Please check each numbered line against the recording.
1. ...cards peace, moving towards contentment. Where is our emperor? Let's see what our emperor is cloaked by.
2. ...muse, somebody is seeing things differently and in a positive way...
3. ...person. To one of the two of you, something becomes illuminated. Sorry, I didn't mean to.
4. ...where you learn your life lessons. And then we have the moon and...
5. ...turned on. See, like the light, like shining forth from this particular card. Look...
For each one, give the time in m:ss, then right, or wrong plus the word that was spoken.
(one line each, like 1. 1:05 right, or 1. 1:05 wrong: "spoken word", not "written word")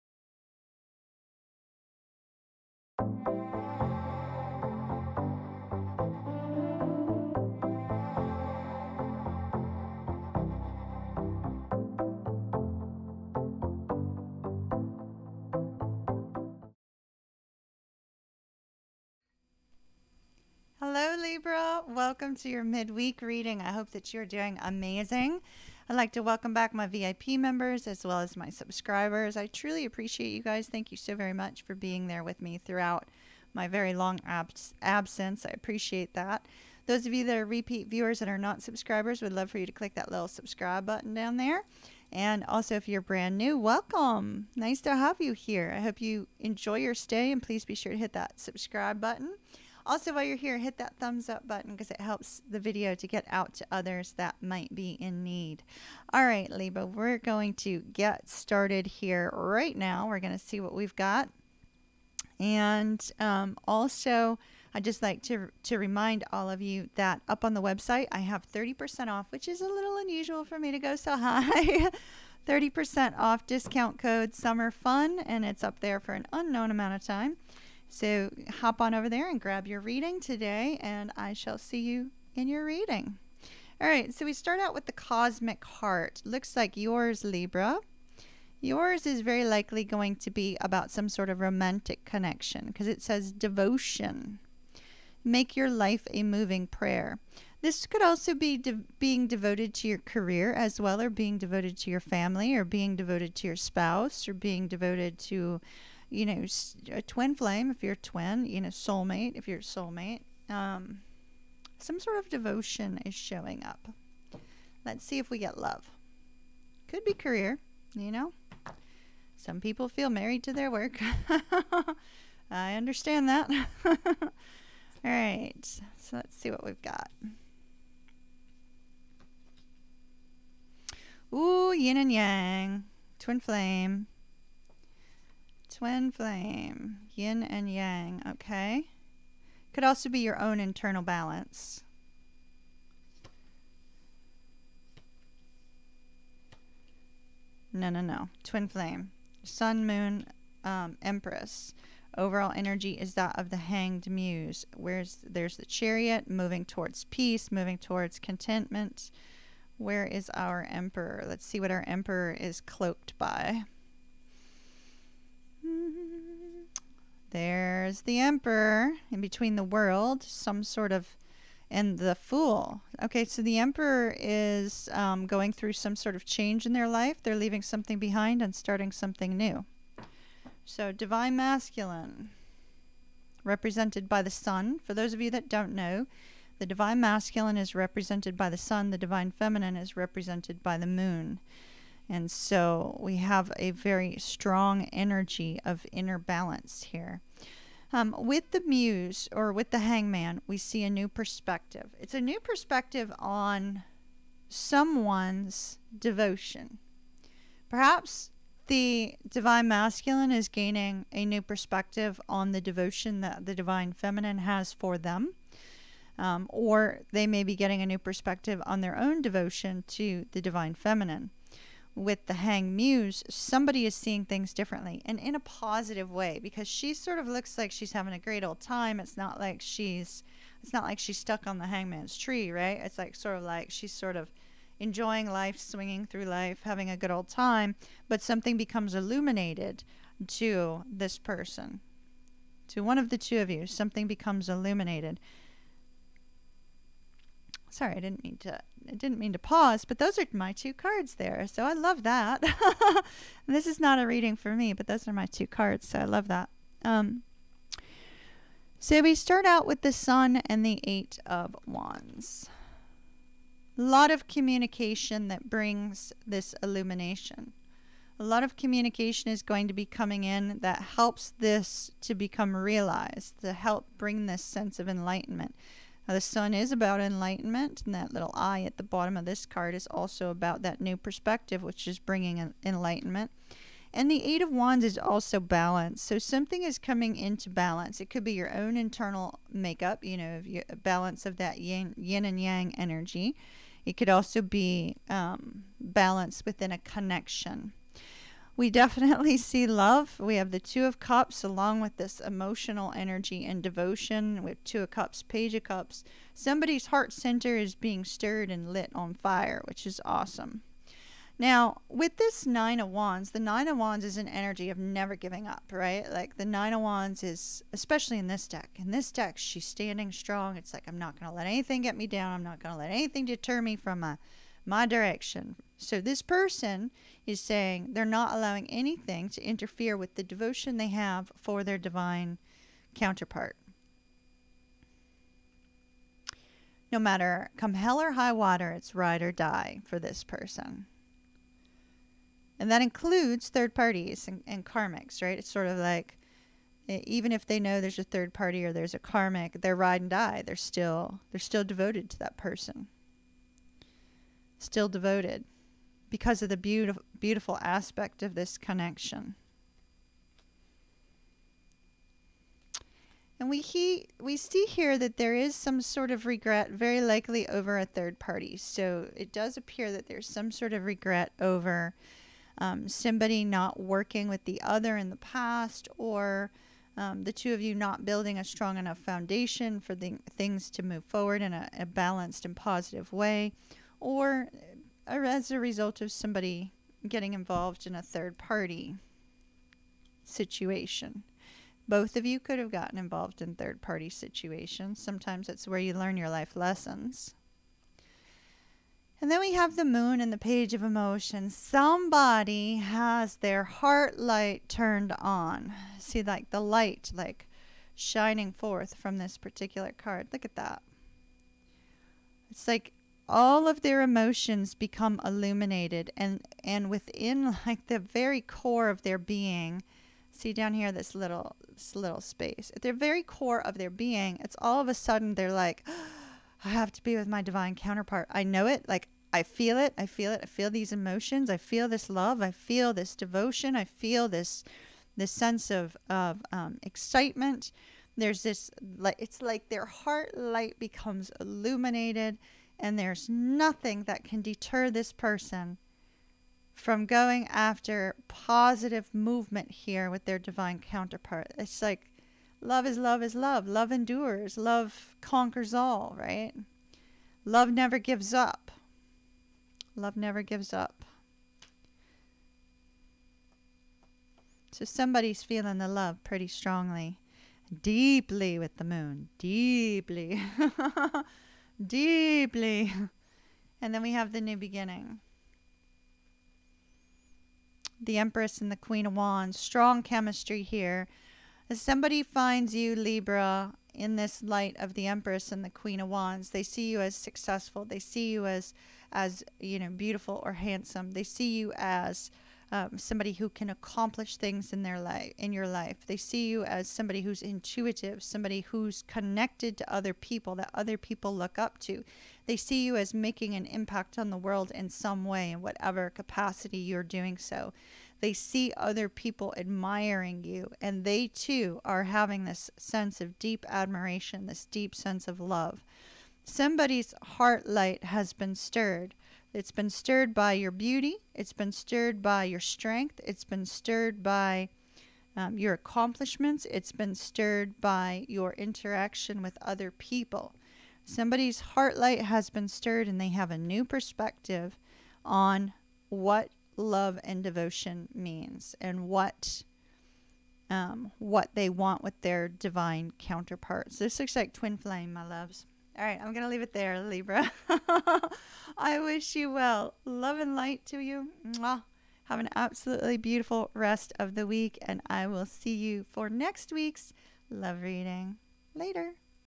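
1. 2:36 wrong: "towards", not "cards"
2. 3:42 right
3. 4:01 right
4. 6:35 right
5. 6:44 right.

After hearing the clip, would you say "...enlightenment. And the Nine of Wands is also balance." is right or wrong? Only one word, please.
wrong.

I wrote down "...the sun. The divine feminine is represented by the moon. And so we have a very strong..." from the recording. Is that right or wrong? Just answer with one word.
right.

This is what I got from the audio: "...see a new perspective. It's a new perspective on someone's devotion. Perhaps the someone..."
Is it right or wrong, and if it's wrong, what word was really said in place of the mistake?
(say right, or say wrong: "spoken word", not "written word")
wrong: "divine", not "someone".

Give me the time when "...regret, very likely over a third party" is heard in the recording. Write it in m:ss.
6:06.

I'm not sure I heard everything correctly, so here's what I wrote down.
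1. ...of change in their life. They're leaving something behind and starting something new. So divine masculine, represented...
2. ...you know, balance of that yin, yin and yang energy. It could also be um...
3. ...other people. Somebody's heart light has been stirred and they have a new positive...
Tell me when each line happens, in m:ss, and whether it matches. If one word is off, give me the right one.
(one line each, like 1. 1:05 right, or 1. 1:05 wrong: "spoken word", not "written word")
1. 2:56 right
2. 4:50 right
3. 8:49 wrong: "perspective", not "positive".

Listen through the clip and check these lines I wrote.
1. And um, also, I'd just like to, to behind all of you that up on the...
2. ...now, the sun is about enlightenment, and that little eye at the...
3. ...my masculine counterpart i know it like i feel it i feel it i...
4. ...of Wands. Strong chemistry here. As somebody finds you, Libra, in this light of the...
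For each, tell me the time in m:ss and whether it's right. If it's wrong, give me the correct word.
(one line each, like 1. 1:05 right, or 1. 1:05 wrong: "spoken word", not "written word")
1. 1:02 wrong: "remind", not "behind"
2. 4:36 right
3. 7:07 wrong: "divine", not "masculine"
4. 7:59 right.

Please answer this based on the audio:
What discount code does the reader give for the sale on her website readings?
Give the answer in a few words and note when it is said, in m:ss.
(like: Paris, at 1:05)
summer fun, at 1:14.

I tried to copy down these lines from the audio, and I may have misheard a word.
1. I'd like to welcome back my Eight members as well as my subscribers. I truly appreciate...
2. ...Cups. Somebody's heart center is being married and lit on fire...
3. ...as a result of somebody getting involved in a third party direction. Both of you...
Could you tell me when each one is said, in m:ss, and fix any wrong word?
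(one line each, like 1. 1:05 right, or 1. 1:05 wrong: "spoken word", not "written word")
1. 0:25 wrong: "VIP", not "Eight"
2. 5:05 wrong: "stirred", not "married"
3. 6:25 wrong: "situation", not "direction".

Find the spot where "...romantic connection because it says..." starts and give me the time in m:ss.
1:31.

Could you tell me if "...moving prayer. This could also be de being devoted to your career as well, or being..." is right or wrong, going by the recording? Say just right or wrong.
right.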